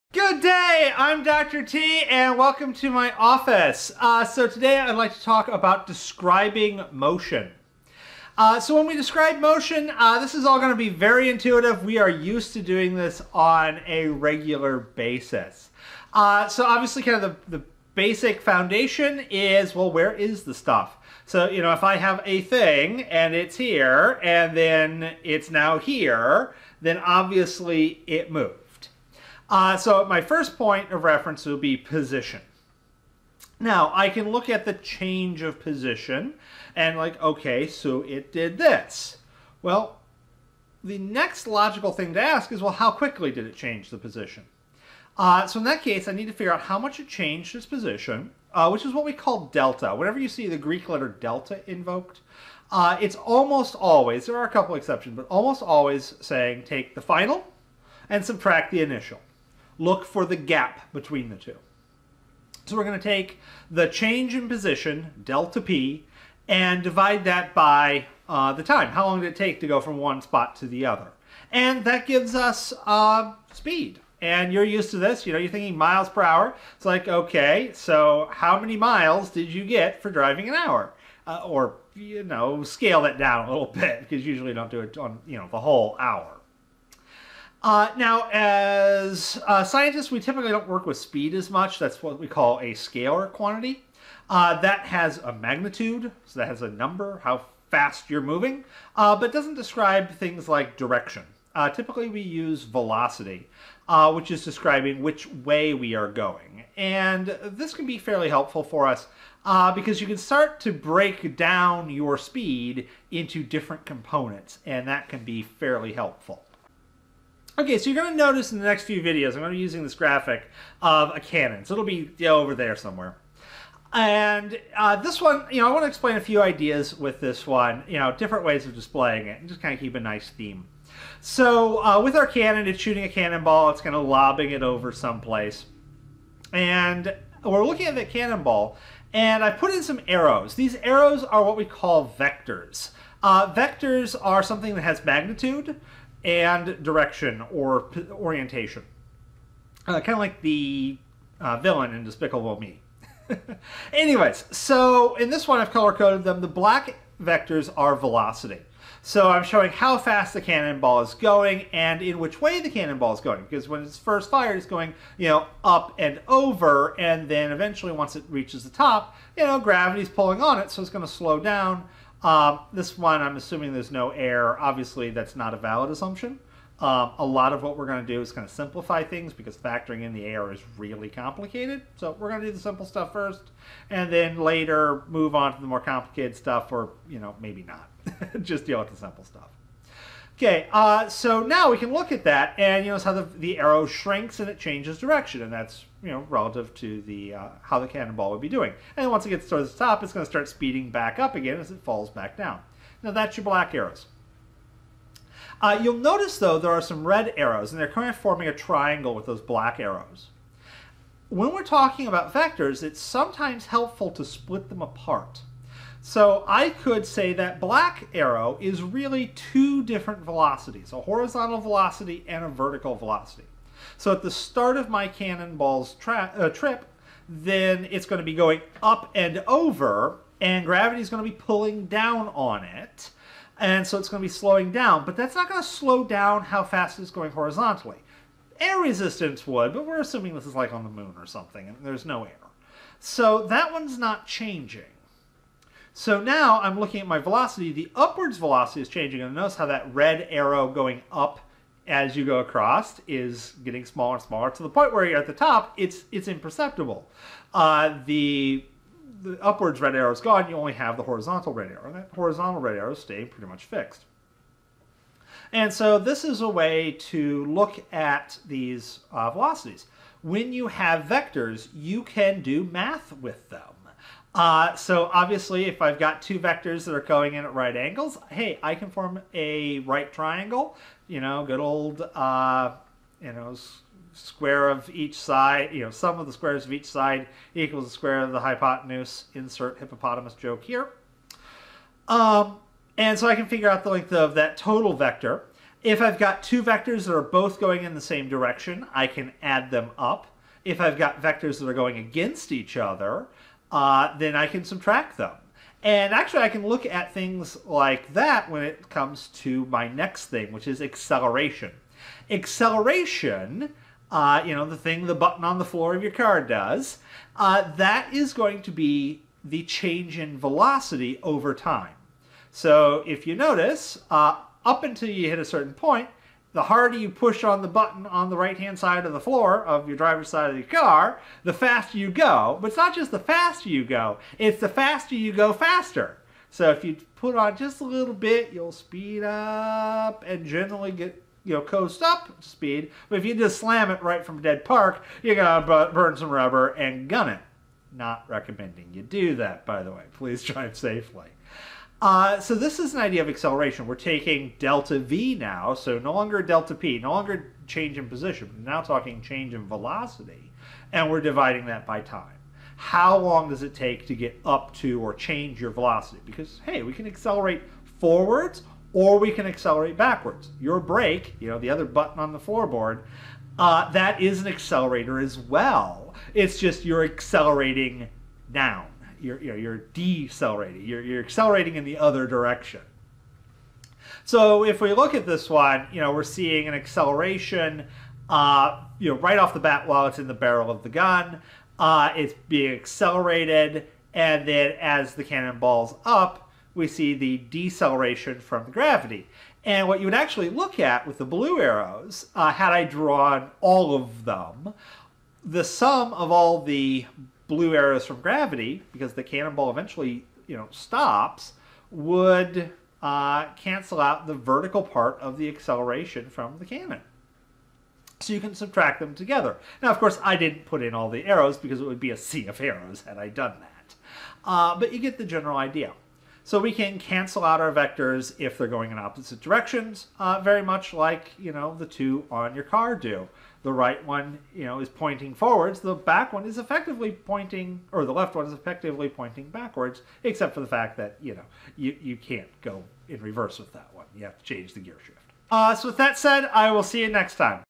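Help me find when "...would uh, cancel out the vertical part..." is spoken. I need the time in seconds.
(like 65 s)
411 s.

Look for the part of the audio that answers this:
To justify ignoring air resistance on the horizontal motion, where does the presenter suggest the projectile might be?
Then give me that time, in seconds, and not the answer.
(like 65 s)
240 s.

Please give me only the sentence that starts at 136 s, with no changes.
And we're looking at the cannonball, and I put in some arrows.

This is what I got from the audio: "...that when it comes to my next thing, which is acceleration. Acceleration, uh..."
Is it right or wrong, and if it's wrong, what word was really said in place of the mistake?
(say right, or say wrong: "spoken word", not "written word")
right.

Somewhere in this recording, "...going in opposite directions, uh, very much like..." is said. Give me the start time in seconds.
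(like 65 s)
428 s.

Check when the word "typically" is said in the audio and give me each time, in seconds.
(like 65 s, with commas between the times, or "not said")
90 s, 101 s.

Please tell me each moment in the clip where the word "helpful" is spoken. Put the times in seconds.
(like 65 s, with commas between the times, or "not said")
108 s, 115 s, 213 s.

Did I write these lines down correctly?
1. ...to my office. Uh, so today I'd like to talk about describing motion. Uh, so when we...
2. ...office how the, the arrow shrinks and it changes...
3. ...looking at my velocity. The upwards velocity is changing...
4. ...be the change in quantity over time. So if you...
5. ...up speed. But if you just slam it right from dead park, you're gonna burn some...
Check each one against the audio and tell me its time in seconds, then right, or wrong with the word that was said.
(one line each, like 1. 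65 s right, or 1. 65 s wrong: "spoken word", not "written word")
1. 2 s right
2. 192 s wrong: "notice", not "office"
3. 246 s right
4. 318 s wrong: "velocity", not "quantity"
5. 342 s right.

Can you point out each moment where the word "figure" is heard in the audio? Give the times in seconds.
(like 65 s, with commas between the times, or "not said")
46 s, 293 s.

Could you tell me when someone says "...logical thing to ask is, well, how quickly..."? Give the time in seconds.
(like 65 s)
41 s.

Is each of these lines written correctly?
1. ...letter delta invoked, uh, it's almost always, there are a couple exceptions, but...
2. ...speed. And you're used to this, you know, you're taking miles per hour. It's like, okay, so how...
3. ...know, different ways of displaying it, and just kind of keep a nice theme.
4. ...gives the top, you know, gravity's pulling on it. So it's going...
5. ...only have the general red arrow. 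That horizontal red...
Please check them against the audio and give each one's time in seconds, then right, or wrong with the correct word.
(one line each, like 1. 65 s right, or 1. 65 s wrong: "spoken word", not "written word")
1. 50 s right
2. 73 s wrong: "thinking", not "taking"
3. 127 s right
4. 168 s wrong: "reaches", not "gives"
5. 260 s wrong: "horizontal", not "general".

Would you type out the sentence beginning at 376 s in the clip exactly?
It's just you're accelerating now you're, you're, you're decelerating.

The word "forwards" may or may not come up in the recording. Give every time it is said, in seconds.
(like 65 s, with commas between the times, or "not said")
367 s, 435 s.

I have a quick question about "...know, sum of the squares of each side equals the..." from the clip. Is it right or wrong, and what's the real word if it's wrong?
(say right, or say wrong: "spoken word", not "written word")
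right.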